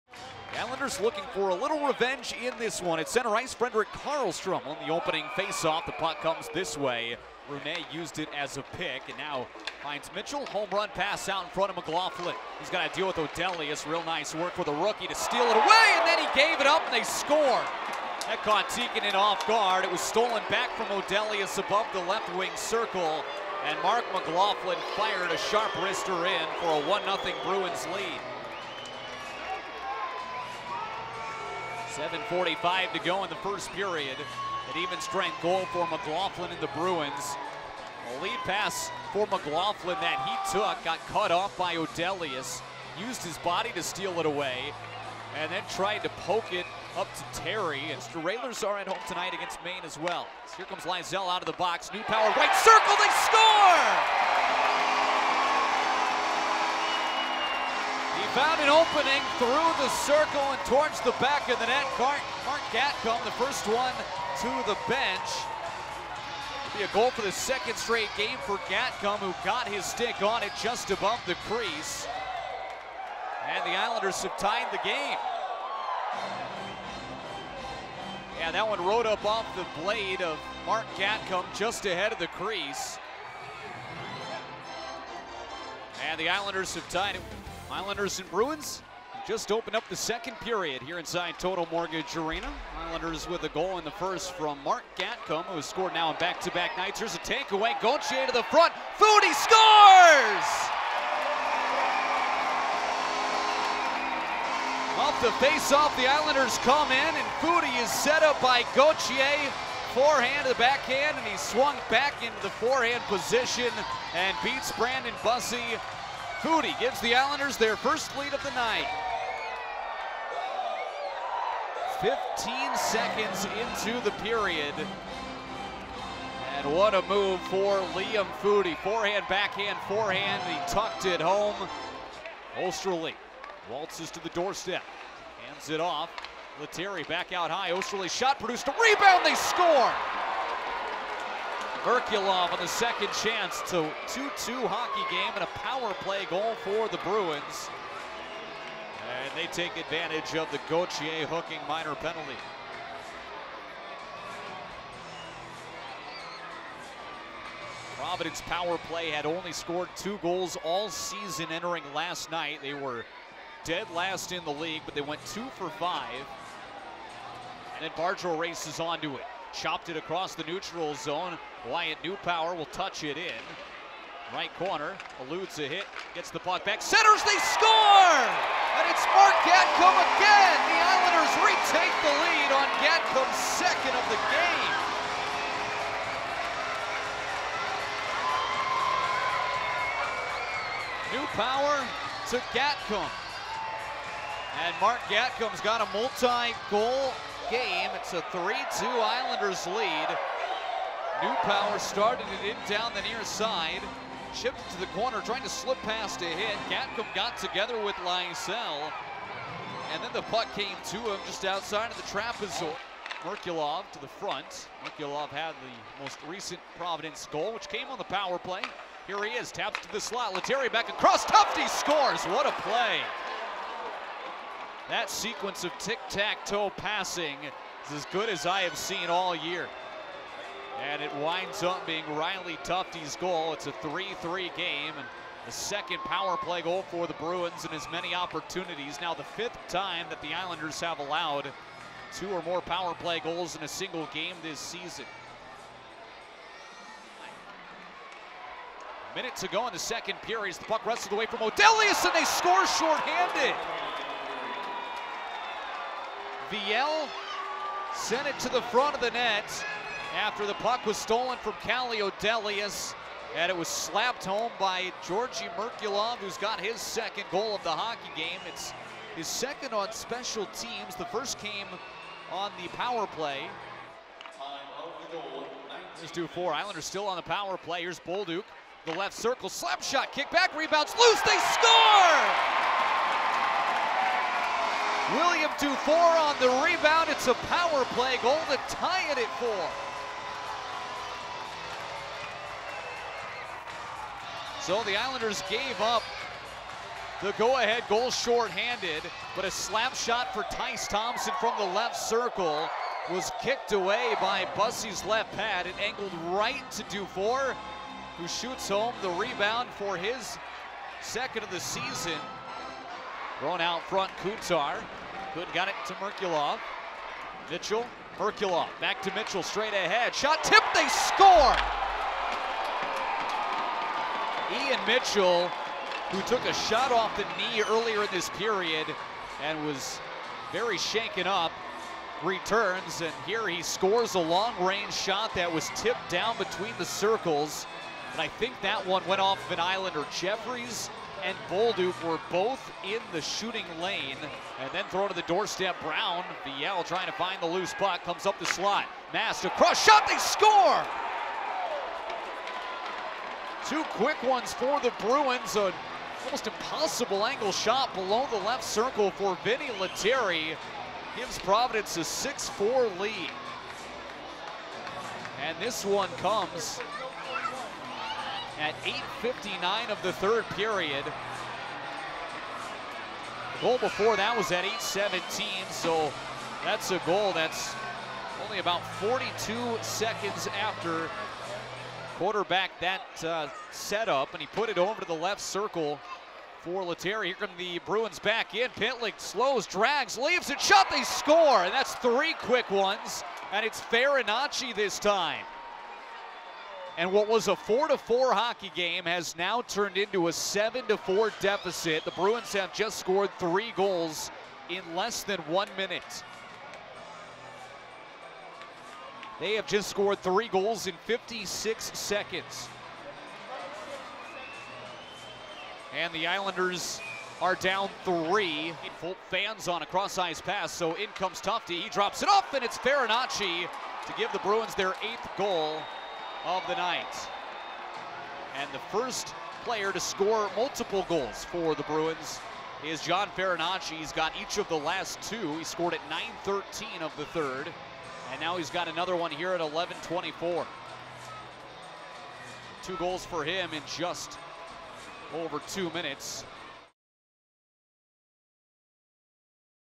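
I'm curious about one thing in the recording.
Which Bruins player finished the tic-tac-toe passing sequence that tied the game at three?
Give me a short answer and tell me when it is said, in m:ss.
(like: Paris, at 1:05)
Riley Tufte, at 3:52.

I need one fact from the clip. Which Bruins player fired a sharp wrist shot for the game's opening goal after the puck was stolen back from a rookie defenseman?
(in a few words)
Mark McLaughlin.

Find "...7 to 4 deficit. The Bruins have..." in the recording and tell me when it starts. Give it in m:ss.
6:40.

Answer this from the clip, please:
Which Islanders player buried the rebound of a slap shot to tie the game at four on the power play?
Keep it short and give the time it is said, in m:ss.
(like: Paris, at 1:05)
William Dufour, at 4:45.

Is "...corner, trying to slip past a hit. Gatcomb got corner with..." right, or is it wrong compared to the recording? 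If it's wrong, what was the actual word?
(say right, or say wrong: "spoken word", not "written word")
wrong: "together", not "corner".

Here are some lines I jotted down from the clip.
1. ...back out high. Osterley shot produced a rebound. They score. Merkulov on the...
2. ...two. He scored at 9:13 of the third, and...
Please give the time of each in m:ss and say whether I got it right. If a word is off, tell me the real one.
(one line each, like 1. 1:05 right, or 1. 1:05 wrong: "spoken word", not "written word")
1. 2:17 right
2. 7:15 right.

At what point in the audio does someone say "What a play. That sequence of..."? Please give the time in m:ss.
3:42.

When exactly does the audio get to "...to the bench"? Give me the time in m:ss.
1:04.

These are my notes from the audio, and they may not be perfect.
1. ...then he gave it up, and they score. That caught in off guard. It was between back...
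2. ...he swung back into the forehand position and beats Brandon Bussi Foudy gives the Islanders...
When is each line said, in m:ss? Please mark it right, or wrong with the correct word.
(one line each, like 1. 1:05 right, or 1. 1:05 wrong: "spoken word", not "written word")
1. 0:16 wrong: "stolen", not "between"
2. 1:51 right.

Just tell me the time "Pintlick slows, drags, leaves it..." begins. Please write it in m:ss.
6:28.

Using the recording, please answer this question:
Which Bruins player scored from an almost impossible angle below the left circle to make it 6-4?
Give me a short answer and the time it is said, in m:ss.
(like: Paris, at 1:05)
Vinny Lettieri, at 5:59.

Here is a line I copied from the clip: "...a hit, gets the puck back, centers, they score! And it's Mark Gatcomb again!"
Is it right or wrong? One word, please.
right.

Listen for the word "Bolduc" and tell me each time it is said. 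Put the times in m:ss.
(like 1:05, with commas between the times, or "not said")
4:38, 5:41.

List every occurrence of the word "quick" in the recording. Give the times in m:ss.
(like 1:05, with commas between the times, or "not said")
5:53, 6:32.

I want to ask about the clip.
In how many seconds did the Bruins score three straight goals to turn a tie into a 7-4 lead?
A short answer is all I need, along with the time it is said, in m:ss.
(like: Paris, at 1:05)
56, at 6:51.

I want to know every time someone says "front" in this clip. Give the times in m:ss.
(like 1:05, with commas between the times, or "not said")
0:11, 1:38, 3:34, 4:18, 5:13.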